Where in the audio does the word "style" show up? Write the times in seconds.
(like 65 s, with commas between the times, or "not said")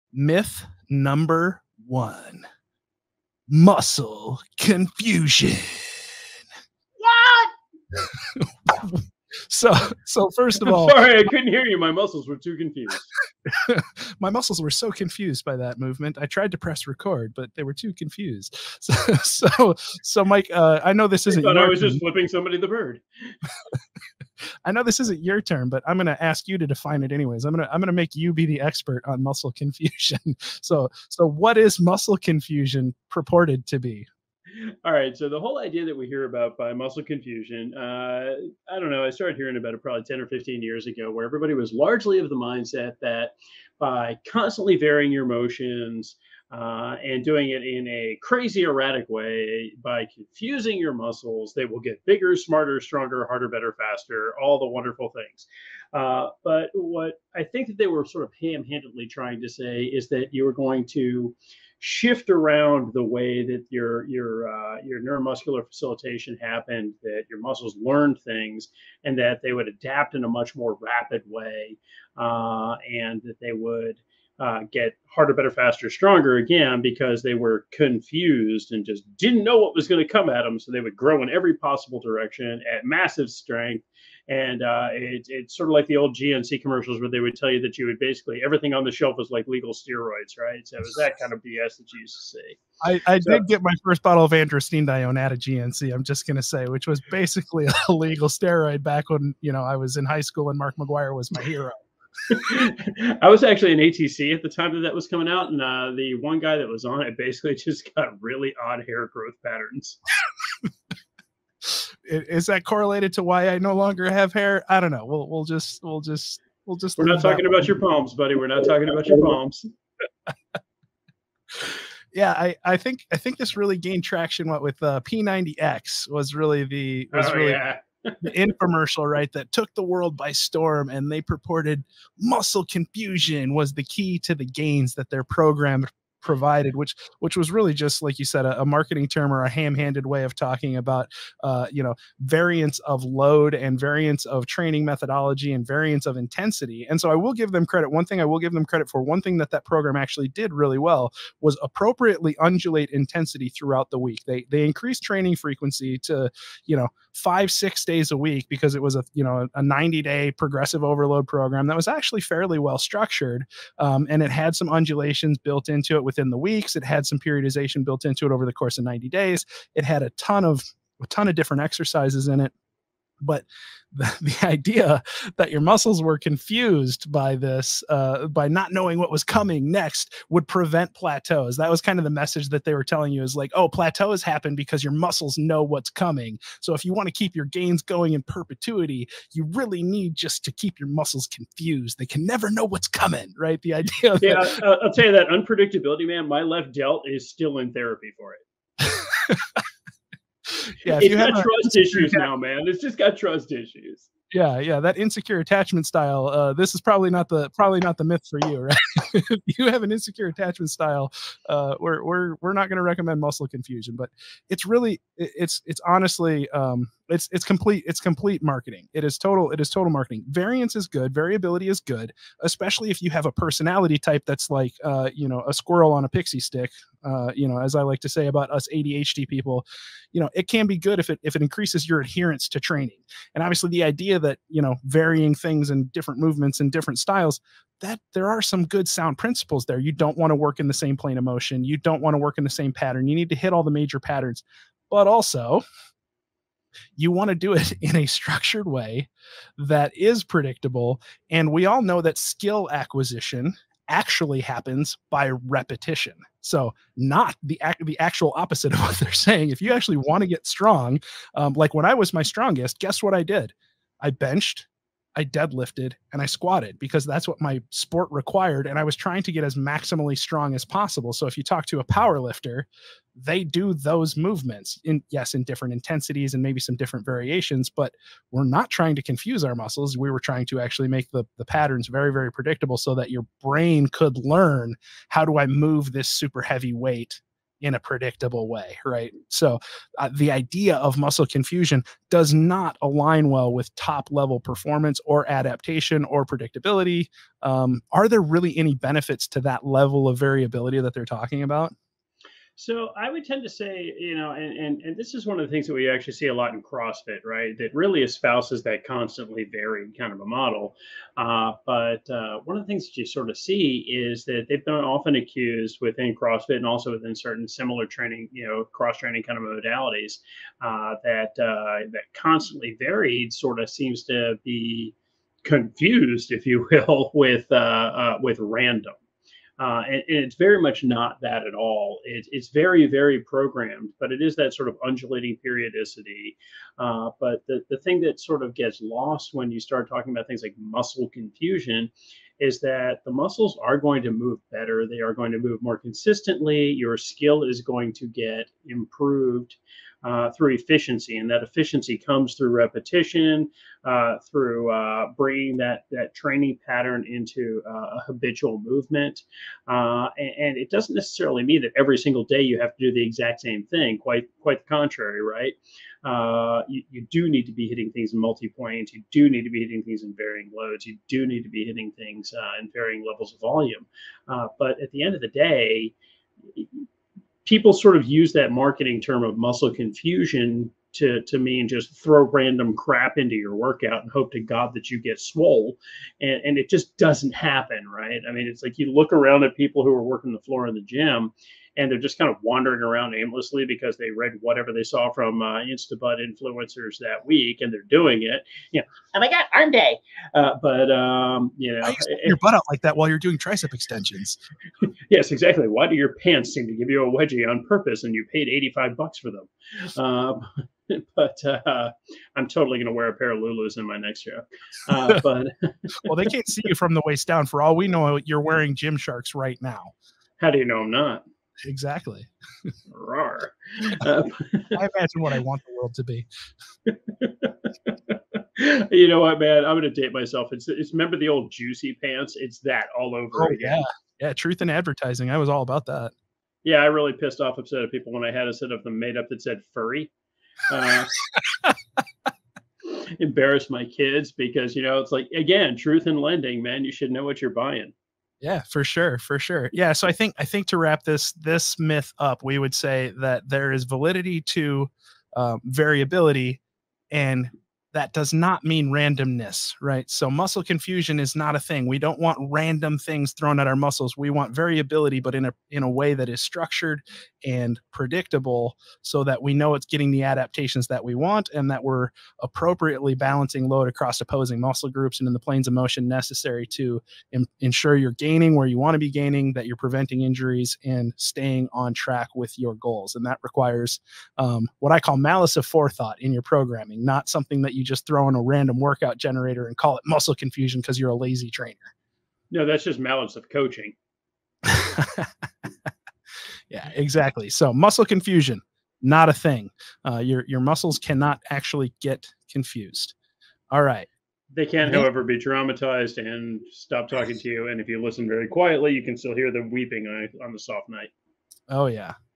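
205 s, 210 s, 236 s.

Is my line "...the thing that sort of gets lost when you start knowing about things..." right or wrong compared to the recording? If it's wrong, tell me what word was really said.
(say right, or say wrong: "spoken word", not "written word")
wrong: "talking", not "knowing".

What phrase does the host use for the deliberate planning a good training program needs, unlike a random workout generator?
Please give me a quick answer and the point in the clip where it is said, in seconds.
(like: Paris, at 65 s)
malice of forethought, at 485 s.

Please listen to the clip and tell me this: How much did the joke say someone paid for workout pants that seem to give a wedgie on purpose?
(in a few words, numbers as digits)
85 bucks.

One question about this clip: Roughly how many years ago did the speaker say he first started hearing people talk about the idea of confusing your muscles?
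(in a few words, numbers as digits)
10 or 15 years.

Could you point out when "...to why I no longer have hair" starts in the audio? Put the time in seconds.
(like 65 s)
113 s.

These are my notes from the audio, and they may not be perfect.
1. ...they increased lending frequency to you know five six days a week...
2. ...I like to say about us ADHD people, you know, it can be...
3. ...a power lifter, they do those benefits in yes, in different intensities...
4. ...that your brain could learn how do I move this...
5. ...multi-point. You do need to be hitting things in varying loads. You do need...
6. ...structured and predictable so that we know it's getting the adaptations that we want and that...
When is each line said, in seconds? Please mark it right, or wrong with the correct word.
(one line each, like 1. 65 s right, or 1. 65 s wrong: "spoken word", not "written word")
1. 154 s wrong: "training", not "lending"
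2. 227 s right
3. 271 s wrong: "movements", not "benefits"
4. 282 s right
5. 368 s right
6. 466 s right.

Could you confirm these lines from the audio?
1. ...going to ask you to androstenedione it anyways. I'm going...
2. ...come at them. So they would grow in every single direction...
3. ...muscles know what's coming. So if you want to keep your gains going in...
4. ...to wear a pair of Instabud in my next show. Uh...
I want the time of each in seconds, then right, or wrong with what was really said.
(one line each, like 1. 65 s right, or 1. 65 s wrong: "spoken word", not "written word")
1. 25 s wrong: "define", not "androstenedione"
2. 80 s wrong: "possible", not "single"
3. 184 s right
4. 412 s wrong: "Lulus", not "Instabud".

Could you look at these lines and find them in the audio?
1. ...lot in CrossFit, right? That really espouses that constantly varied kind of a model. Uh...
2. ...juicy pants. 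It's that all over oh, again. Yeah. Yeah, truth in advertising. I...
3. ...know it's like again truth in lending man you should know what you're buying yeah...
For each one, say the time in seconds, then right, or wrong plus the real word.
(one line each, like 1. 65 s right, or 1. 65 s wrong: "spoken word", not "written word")
1. 306 s right
2. 431 s right
3. 444 s right.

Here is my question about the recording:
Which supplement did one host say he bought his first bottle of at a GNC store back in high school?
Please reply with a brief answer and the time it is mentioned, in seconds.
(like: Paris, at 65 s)
androstenedione, at 94 s.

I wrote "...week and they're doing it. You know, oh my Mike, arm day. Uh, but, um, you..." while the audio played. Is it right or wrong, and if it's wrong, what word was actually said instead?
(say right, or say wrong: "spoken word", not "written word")
wrong: "God", not "Mike".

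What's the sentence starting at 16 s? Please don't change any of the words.
I tried to press record, but they were too confused.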